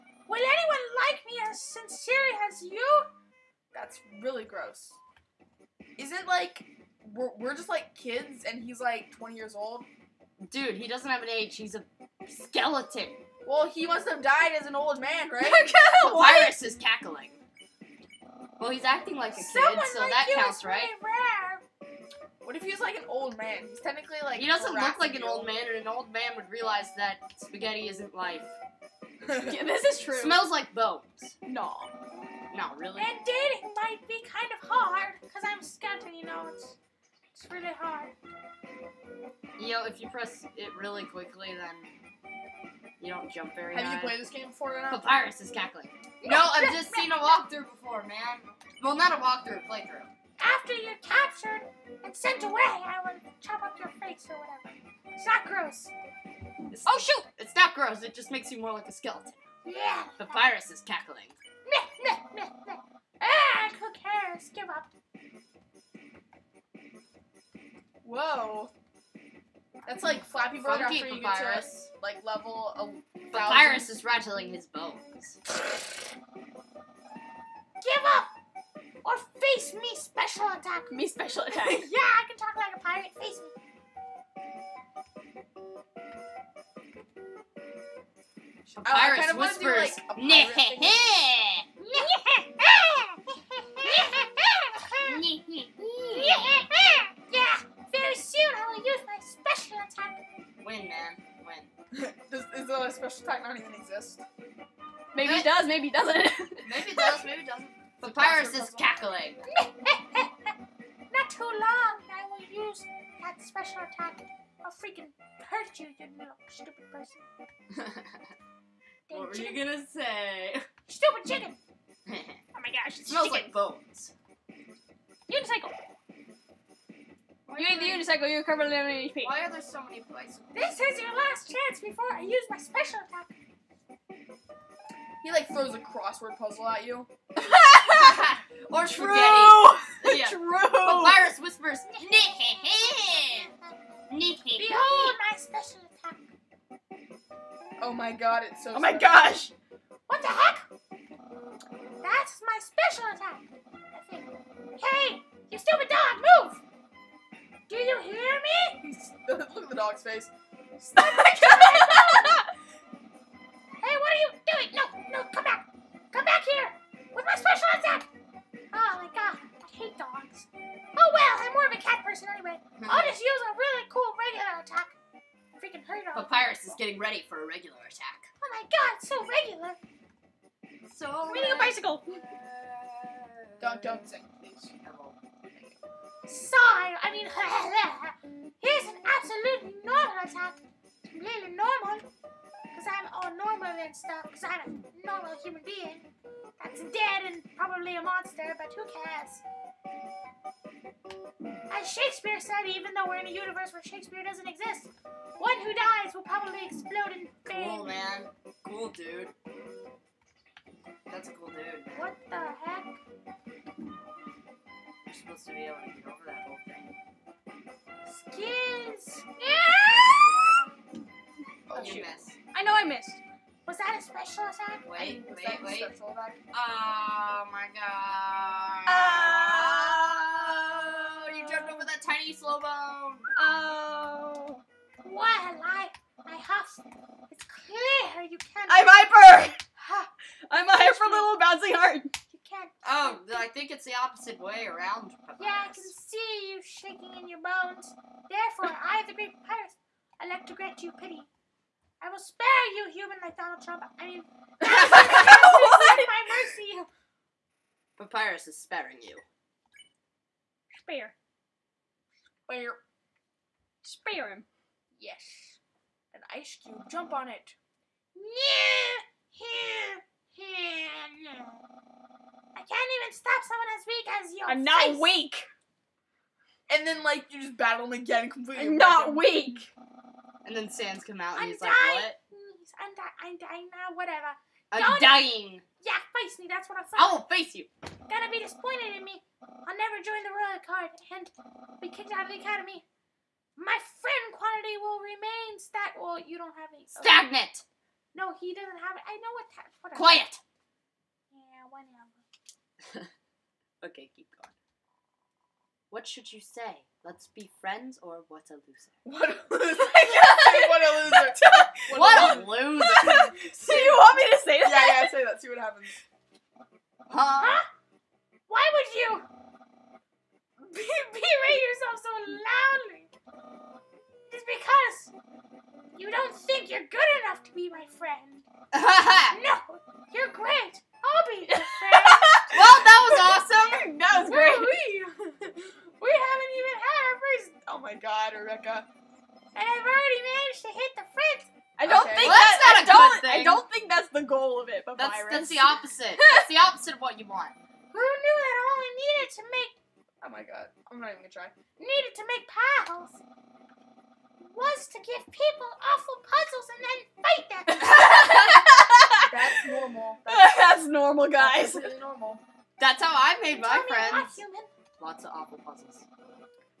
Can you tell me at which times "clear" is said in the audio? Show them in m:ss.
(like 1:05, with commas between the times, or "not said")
3:57.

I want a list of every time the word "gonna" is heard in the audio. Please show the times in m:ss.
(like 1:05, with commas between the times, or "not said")
1:59, 4:48, 5:51.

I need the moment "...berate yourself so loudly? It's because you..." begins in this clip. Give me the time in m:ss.
5:20.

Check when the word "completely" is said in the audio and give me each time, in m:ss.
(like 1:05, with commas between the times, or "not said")
3:11, 4:38.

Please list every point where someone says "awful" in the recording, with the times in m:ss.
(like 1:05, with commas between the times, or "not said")
5:55, 6:05.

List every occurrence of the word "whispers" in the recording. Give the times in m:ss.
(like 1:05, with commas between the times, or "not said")
1:29, 2:21.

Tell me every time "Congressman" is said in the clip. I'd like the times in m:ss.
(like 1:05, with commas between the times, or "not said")
not said.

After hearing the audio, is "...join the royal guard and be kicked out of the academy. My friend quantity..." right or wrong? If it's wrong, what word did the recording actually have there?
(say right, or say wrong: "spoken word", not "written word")
right.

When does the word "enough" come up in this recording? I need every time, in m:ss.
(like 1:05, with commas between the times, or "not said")
5:27.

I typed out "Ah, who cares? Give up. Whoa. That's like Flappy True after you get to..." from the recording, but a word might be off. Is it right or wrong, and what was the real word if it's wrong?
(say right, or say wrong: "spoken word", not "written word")
wrong: "Bird", not "True".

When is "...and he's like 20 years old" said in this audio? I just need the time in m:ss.
0:08.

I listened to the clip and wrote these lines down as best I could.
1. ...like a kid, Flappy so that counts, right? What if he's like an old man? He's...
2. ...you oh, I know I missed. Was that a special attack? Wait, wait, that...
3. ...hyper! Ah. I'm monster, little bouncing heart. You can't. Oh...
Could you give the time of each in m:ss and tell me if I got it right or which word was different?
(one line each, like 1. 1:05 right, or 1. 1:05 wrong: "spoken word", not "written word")
1. 0:19 wrong: "Someone", not "Flappy"
2. 3:41 right
3. 3:58 wrong: "hyper", not "monster".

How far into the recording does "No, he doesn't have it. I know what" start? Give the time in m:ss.
4:58.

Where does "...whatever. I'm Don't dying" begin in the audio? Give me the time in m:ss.
4:43.